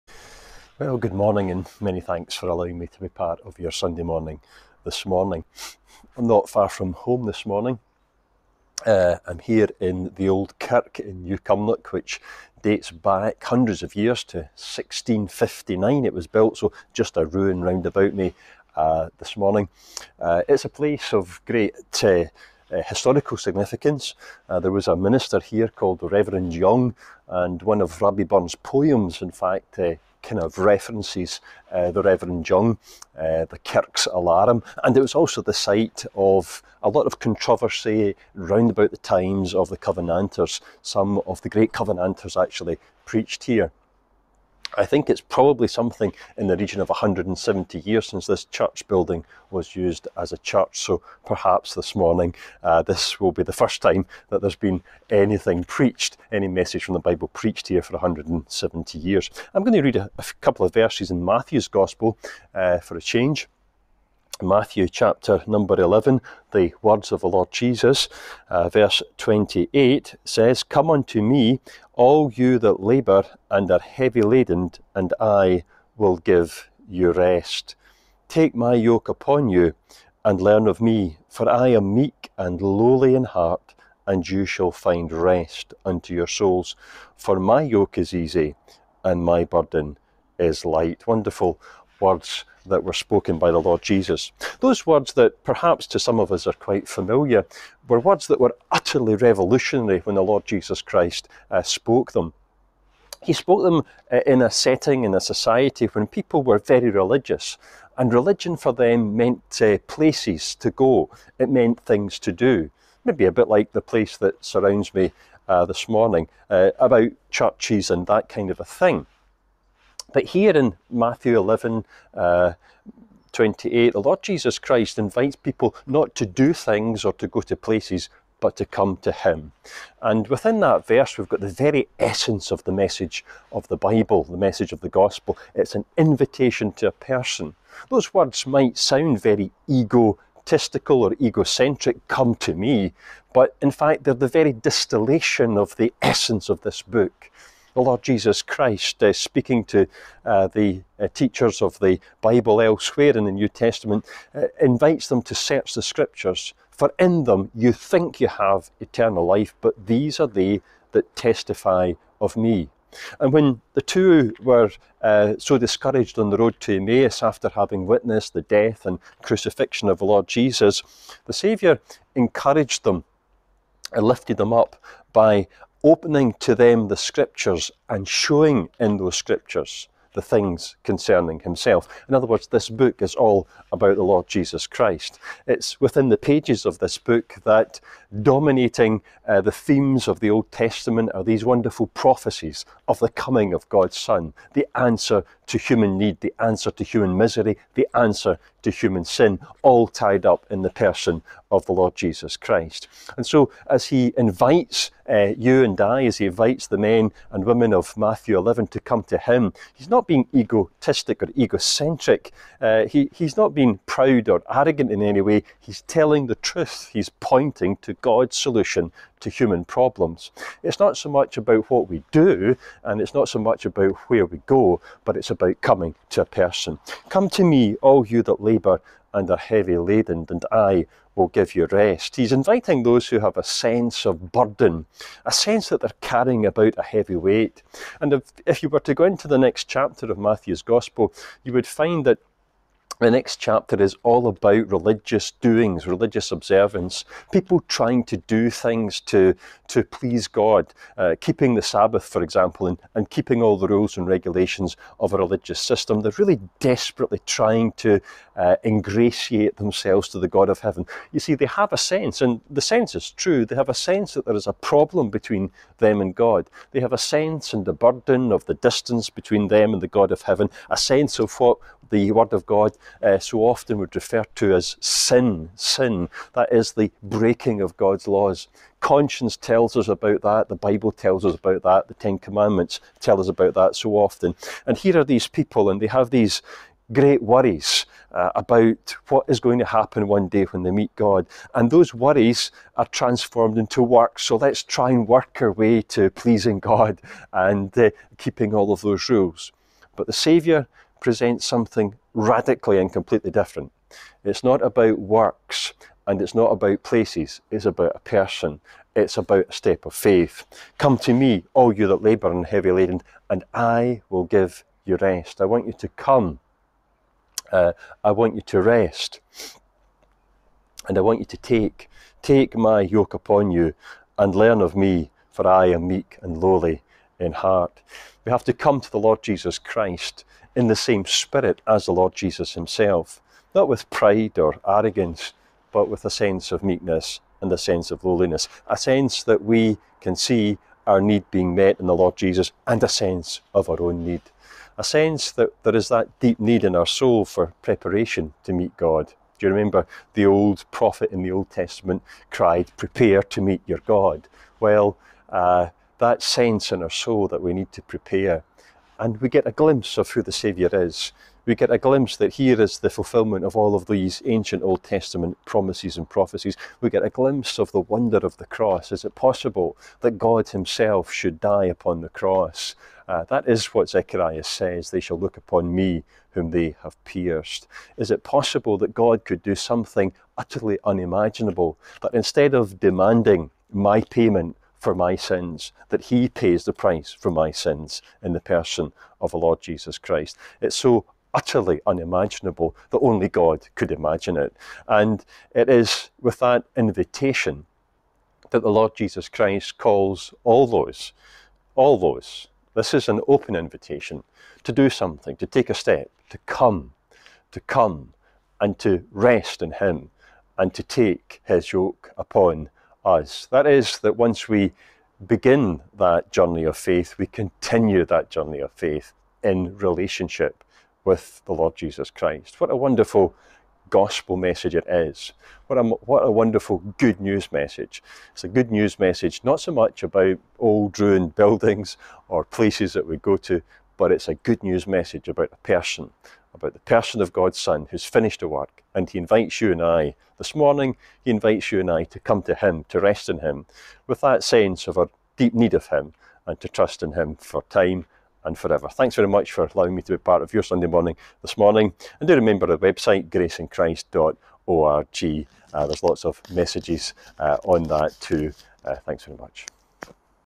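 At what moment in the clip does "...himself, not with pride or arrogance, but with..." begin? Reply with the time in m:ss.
5:32.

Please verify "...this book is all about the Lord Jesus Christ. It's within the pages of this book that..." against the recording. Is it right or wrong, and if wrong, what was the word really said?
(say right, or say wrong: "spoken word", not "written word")
right.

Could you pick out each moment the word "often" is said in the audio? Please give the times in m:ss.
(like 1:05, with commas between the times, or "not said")
4:33, 4:43.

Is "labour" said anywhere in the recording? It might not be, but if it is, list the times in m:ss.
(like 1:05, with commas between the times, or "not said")
1:12, 3:48, 5:12.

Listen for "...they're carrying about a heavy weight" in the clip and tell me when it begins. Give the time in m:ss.
3:55.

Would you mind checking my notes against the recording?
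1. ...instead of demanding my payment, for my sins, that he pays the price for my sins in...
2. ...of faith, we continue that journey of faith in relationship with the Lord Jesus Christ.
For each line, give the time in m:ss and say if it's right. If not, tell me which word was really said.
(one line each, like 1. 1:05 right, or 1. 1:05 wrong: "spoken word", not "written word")
1. 6:22 right
2. 6:56 right.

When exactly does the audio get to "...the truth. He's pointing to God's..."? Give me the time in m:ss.
3:36.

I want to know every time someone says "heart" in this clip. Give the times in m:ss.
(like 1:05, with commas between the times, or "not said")
1:23, 5:27.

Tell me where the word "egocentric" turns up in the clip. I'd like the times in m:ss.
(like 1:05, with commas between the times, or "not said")
2:21, 3:31.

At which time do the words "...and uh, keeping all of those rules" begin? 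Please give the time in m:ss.
4:57.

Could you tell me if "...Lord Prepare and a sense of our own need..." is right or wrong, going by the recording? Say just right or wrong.
wrong.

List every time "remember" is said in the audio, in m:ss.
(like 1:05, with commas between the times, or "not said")
5:49, 7:32.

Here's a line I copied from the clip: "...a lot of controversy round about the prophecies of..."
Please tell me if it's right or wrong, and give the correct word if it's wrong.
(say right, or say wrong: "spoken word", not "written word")
wrong: "times", not "prophecies".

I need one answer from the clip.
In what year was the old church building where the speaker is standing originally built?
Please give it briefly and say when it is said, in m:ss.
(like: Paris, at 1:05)
1659, at 0:14.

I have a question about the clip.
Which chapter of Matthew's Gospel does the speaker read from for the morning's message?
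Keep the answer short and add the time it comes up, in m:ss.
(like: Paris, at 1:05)
Chapter 11, at 1:04.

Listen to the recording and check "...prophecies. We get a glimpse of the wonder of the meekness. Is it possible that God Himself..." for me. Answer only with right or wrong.
wrong.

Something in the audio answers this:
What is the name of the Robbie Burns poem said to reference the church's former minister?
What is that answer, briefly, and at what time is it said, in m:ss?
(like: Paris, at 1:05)
The Kirk's Alarm, at 0:33.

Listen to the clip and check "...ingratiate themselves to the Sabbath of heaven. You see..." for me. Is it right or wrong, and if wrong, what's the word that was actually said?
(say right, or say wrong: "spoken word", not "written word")
wrong: "God", not "Sabbath".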